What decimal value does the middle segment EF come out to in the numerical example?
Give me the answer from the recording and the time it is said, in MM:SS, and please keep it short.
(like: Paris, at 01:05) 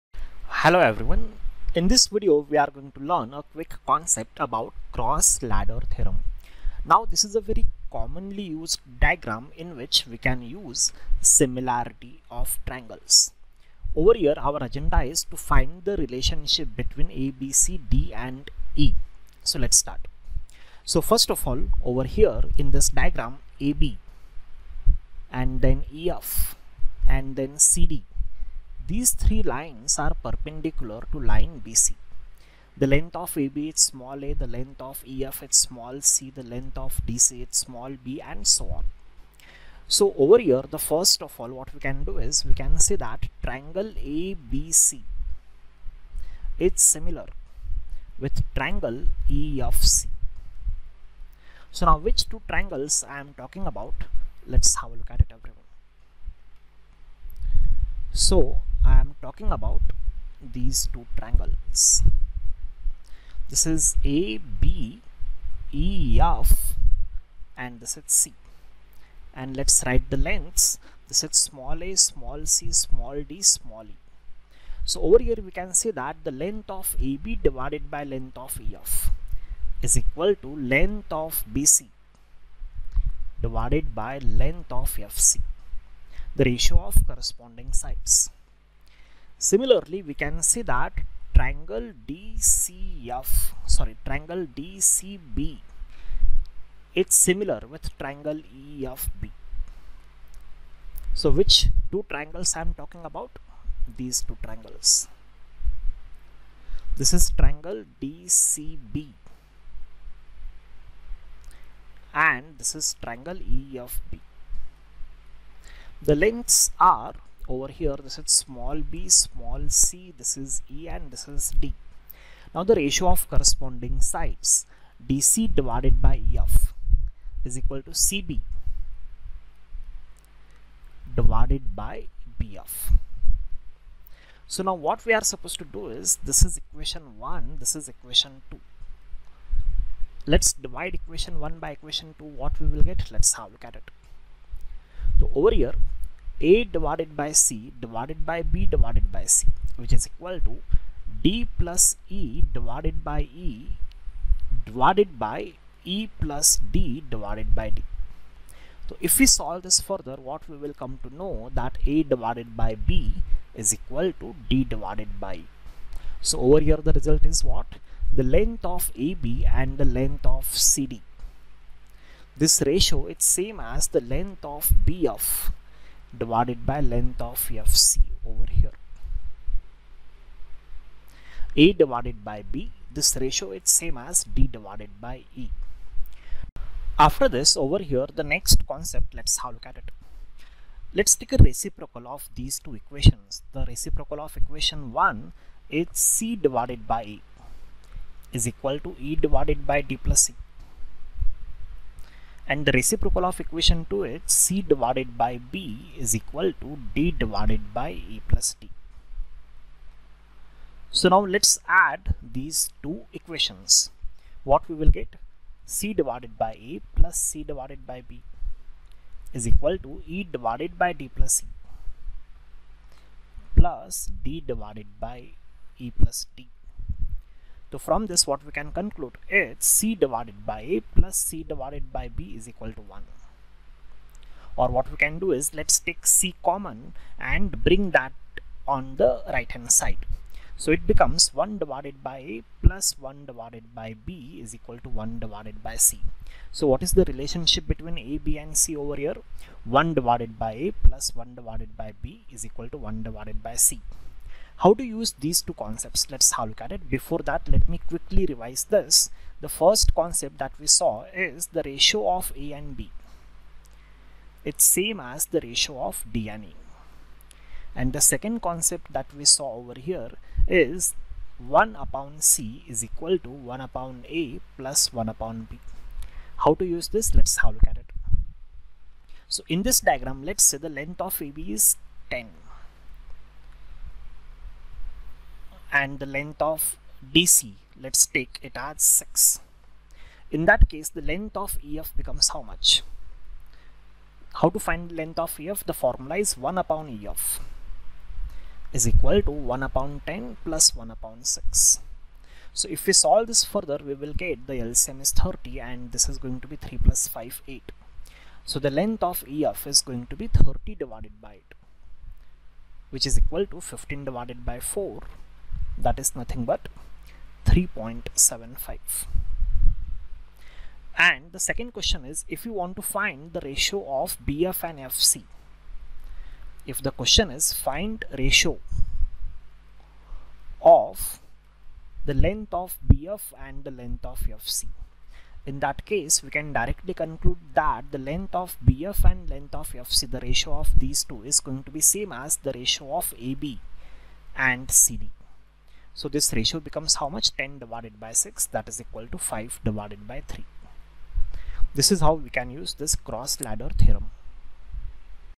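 3.75, at 05:17.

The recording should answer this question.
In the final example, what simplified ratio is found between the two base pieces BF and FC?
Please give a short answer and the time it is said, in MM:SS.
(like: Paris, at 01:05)
5 to 3, at 05:49.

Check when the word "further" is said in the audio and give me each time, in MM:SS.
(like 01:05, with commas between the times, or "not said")
02:39, 05:03.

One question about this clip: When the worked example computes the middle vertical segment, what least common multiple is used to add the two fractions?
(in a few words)
30.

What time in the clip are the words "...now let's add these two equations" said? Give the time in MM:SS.
03:31.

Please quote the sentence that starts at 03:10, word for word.
Let's take a reciprocal of these two equations.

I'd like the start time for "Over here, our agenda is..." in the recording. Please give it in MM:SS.
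00:13.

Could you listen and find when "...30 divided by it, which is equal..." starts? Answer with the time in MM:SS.
05:10.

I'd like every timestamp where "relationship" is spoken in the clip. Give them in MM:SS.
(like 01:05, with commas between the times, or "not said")
00:15, 04:07.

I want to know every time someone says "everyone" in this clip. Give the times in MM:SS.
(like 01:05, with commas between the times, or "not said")
00:00, 00:55.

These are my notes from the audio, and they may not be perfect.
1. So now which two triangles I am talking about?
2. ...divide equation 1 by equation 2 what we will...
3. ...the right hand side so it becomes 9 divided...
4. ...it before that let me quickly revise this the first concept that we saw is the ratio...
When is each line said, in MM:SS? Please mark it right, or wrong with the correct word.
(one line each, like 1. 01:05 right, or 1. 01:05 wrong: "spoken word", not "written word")
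1. 00:51 right
2. 02:20 right
3. 03:59 wrong: "1", not "9"
4. 04:16 right.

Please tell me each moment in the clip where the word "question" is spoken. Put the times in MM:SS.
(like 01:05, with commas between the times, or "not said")
05:21, 05:26.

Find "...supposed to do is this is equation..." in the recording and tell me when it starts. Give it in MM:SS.
02:15.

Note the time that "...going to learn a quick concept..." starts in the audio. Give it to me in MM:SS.
00:02.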